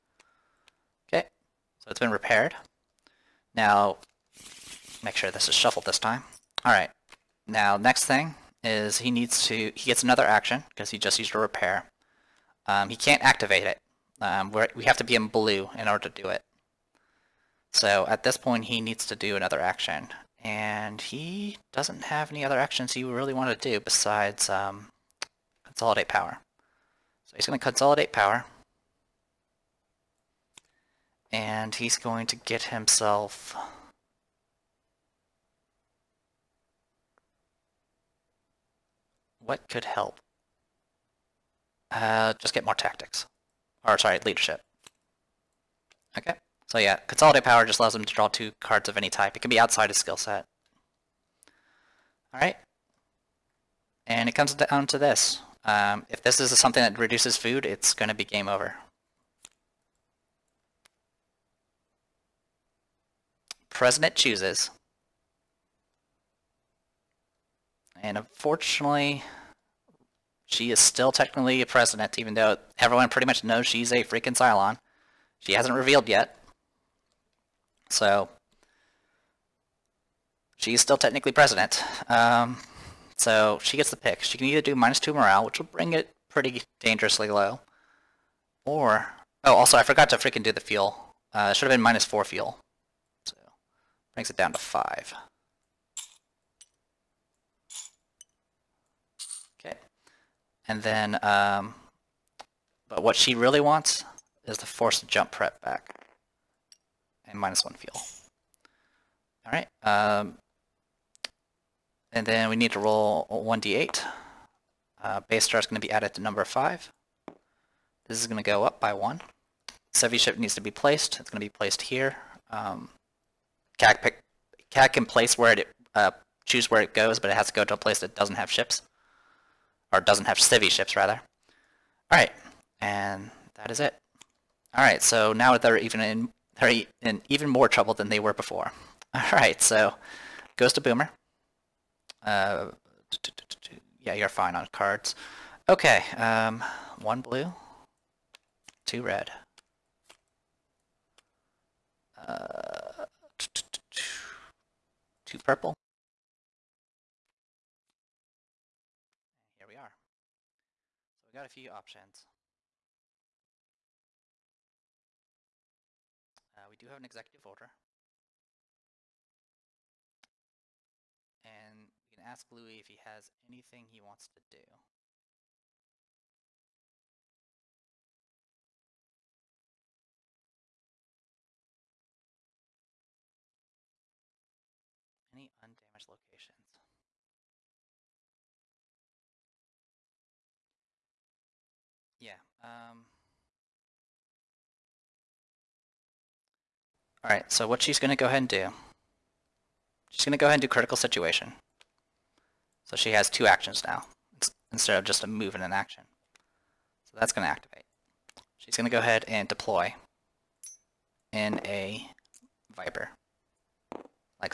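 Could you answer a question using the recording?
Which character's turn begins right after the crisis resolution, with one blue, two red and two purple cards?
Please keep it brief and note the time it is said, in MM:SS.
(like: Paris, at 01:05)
Boomer, at 02:20.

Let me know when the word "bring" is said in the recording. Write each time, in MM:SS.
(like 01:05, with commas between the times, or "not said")
01:25, 01:34.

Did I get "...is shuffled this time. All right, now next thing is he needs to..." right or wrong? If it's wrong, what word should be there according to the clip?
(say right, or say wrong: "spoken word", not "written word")
right.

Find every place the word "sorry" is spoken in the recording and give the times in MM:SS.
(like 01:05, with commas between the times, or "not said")
00:43.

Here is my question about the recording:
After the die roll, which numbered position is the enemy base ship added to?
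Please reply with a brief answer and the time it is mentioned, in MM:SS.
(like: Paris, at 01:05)
5, at 01:56.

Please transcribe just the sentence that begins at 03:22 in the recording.
So she has two actions now, instead of just a move and an action.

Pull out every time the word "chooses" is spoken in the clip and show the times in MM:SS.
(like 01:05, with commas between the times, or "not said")
01:04, 02:06.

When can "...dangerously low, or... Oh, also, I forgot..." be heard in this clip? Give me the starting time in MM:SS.
01:26.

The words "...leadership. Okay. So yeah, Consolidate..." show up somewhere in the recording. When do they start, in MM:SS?
00:44.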